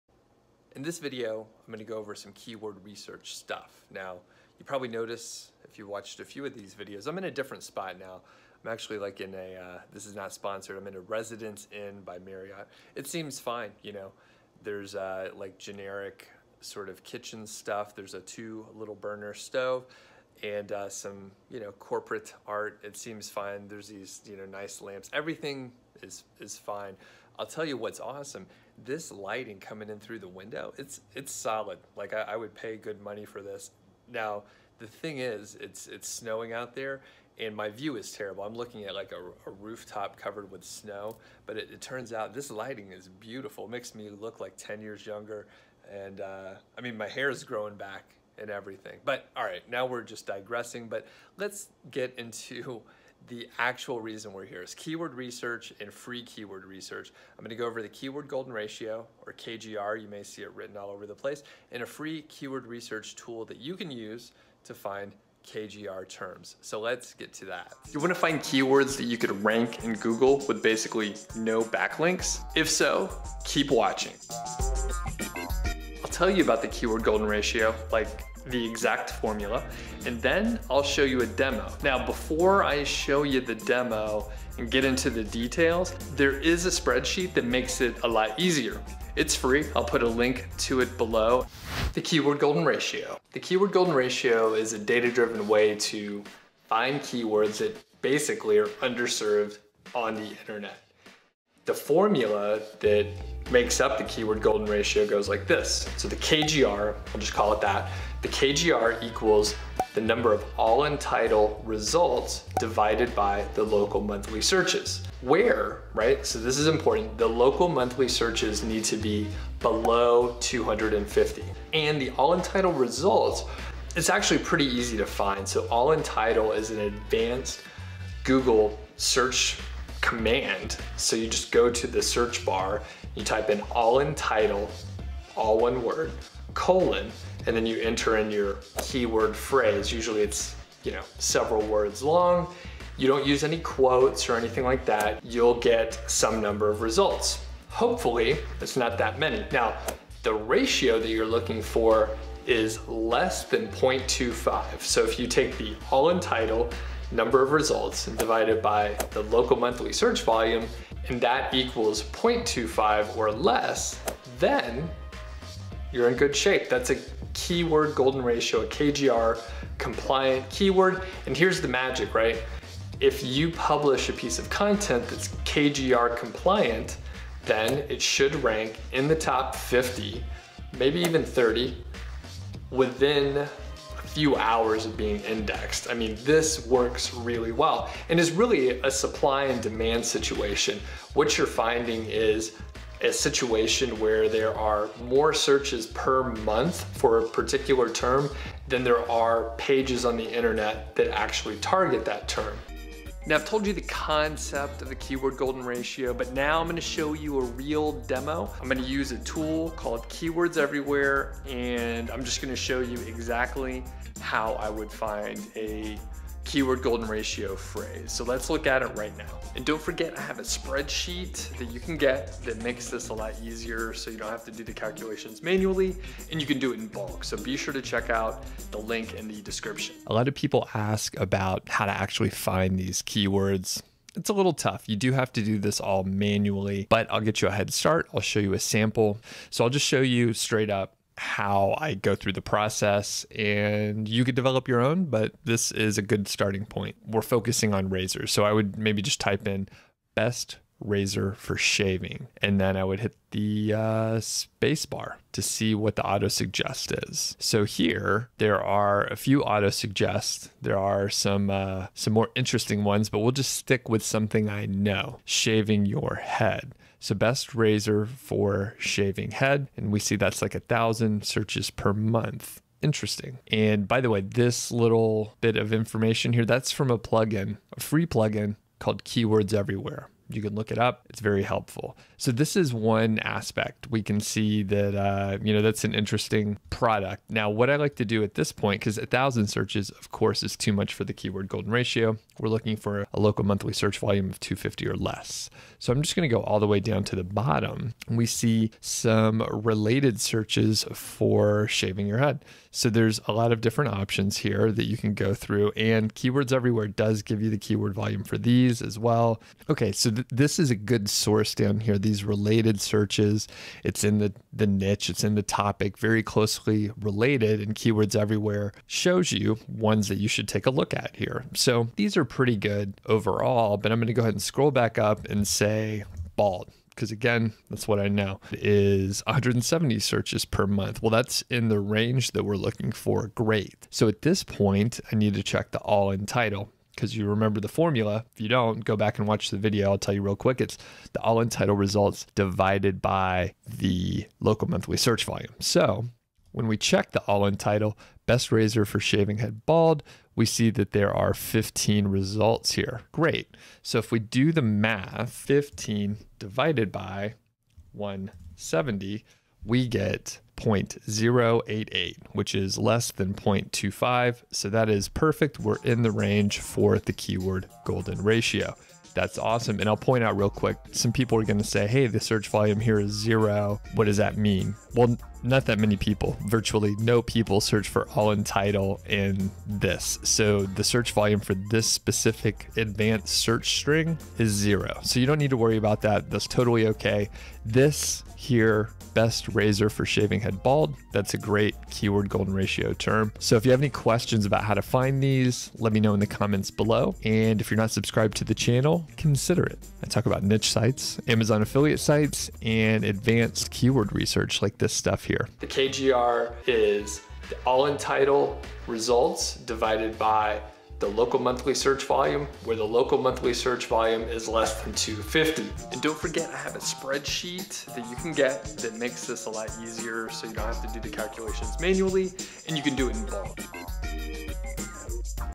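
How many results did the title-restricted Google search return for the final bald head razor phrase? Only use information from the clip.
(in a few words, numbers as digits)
15.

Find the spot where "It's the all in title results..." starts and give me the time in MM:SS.
05:40.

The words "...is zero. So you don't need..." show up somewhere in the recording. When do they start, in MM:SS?
06:24.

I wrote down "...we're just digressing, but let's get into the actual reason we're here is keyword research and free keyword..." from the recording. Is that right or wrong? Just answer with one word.
right.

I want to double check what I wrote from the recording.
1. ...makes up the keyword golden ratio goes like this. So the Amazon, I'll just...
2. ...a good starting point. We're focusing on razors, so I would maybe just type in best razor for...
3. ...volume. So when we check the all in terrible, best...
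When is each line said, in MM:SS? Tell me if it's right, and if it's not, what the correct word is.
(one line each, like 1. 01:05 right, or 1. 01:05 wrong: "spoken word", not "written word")
1. 01:43 wrong: "KGR", not "Amazon"
2. 04:05 right
3. 05:45 wrong: "title", not "terrible".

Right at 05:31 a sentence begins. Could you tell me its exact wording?
Well, that's in the range that we're looking for.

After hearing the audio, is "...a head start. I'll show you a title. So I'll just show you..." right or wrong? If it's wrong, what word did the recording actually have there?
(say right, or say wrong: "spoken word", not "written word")
wrong: "sample", not "title".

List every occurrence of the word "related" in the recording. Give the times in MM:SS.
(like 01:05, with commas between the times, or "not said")
04:59, 05:12, 05:16.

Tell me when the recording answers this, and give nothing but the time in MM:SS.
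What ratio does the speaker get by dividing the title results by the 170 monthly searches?
06:00.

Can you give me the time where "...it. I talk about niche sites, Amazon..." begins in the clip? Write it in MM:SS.
06:39.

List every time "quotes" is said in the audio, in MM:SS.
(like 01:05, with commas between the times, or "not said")
02:23.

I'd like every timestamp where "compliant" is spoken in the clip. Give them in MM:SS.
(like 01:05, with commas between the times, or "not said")
02:49, 02:56.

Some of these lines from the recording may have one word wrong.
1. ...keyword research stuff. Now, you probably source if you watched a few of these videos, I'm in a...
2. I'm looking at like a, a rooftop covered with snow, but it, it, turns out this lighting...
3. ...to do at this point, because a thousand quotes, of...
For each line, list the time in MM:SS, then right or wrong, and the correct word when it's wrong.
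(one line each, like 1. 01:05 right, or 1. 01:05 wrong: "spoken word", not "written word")
1. 00:02 wrong: "notice", not "source"
2. 00:38 right
3. 04:47 wrong: "searches", not "quotes".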